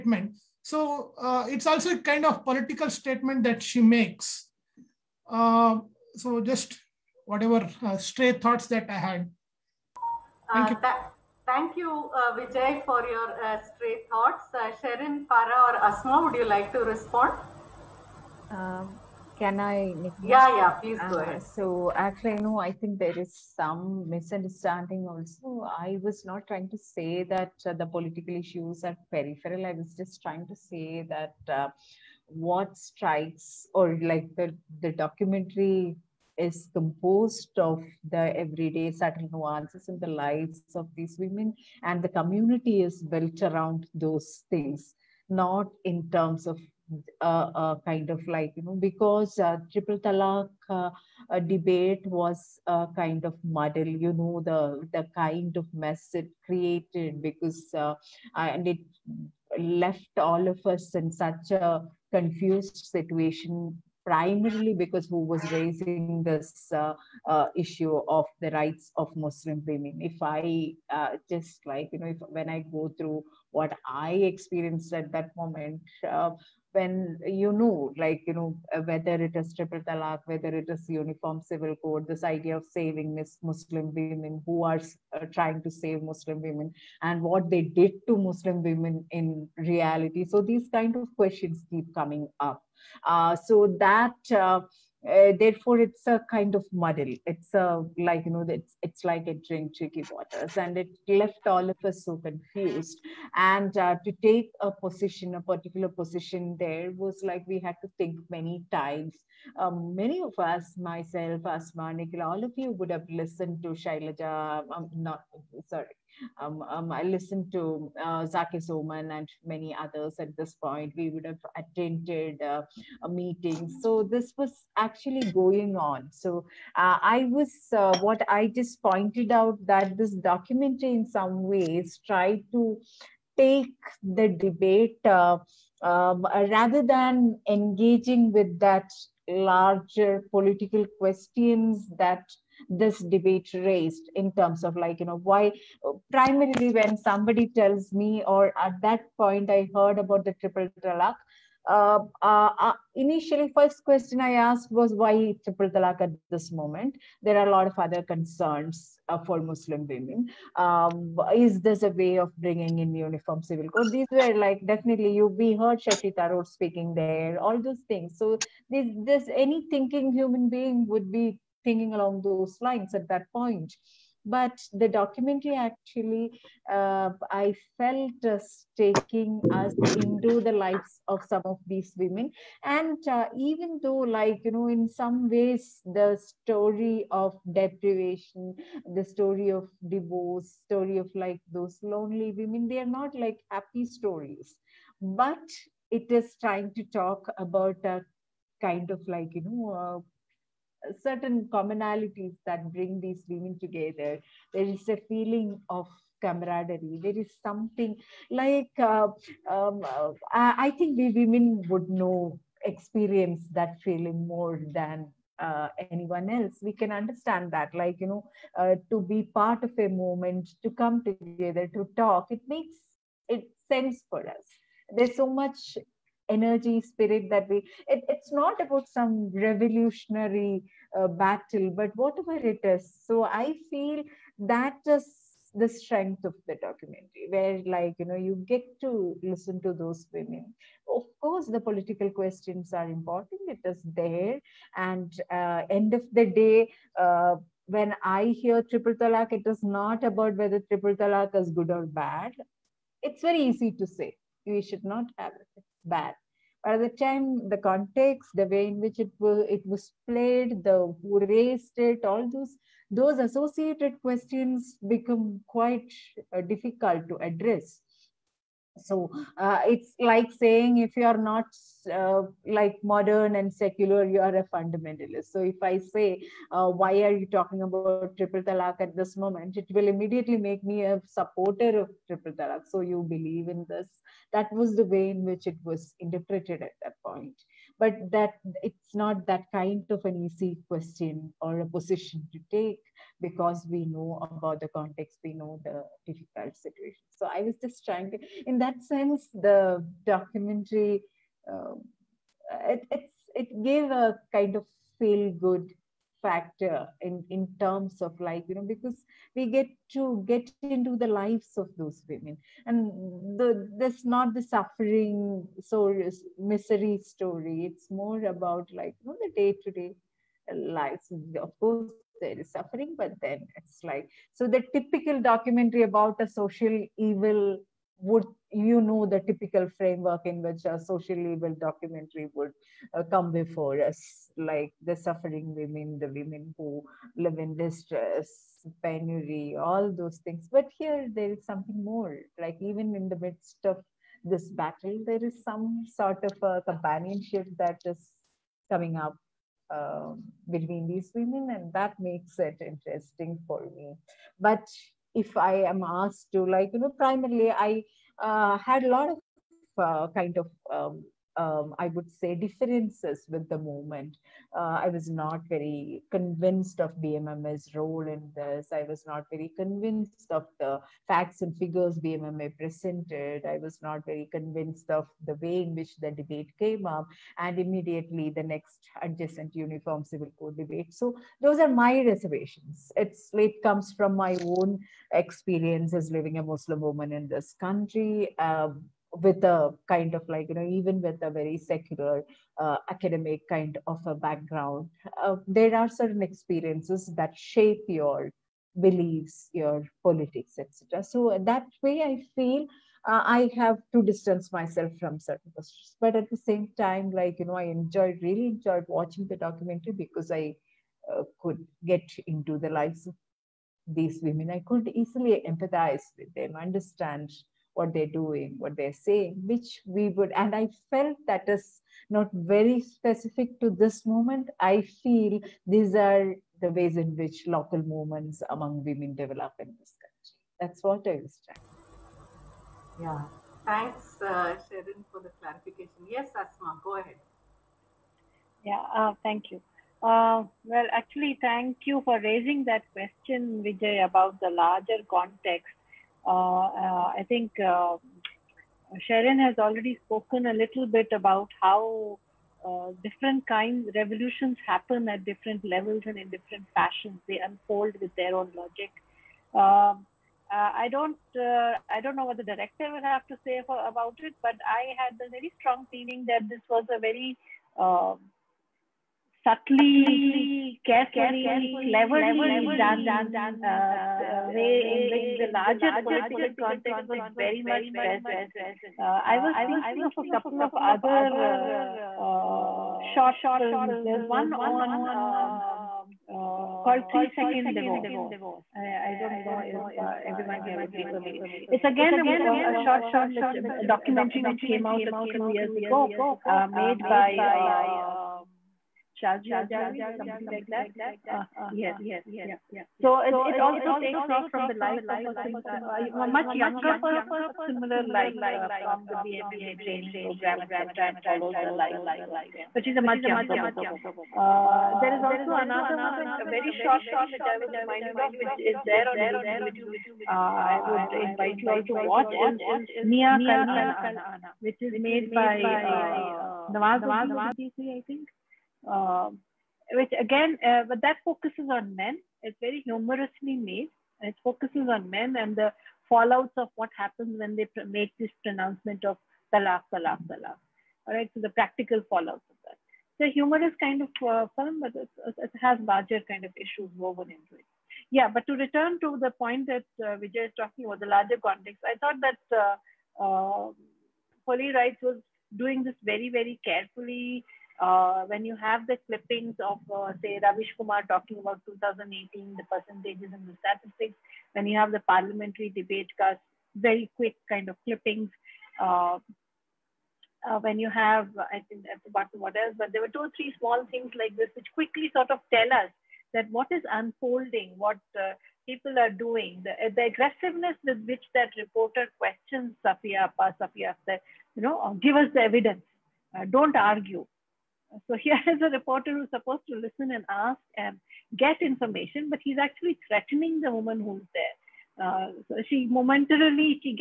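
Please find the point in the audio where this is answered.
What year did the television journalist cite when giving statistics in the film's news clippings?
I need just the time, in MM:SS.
09:21.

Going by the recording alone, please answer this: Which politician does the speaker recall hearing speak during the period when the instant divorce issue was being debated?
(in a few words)
Shashi Tharoor.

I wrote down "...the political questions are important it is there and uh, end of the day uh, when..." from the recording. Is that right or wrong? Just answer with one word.
right.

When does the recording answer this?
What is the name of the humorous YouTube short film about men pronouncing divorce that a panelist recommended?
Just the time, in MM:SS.
08:43.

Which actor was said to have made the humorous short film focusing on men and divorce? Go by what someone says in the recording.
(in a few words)
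Nawazuddin Siddiqui.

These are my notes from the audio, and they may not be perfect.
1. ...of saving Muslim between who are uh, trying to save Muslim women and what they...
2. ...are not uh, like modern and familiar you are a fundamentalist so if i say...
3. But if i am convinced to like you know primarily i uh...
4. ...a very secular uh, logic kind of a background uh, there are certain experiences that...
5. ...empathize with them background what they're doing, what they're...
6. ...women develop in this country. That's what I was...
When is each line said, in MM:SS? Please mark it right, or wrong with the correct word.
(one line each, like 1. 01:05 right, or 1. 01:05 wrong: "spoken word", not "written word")
1. 01:22 wrong: "women", not "between"
2. 04:31 wrong: "secular", not "familiar"
3. 05:54 wrong: "asked", not "convinced"
4. 06:31 wrong: "academic", not "logic"
5. 06:55 wrong: "understand", not "background"
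6. 07:08 right.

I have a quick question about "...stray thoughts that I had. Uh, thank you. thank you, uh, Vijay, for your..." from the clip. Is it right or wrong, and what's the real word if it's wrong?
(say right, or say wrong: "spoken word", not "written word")
right.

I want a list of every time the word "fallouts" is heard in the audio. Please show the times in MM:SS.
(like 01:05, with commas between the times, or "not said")
08:56, 09:02.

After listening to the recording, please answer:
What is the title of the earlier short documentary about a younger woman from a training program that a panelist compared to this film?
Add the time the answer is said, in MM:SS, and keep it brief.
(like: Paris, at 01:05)
Three Second Divorce, at 08:07.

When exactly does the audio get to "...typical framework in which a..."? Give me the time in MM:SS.
05:29.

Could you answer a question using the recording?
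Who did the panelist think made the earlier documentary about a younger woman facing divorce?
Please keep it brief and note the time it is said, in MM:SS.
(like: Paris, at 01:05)
Shazia Javed, at 08:19.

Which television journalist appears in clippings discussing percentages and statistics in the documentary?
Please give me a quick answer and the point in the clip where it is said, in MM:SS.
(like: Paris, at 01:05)
Ravish Kumar, at 09:20.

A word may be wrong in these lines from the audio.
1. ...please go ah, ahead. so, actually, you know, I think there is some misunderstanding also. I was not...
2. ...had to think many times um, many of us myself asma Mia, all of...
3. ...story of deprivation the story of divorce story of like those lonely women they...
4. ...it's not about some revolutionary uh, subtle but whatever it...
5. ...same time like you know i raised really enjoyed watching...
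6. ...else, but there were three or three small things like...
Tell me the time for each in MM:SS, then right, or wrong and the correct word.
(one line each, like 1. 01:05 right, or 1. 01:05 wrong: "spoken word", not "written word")
1. 00:20 right
2. 01:47 wrong: "Nikhil", not "Mia"
3. 03:06 right
4. 03:48 wrong: "battle", not "subtle"
5. 06:46 wrong: "enjoyed", not "raised"
6. 09:32 wrong: "two", not "three".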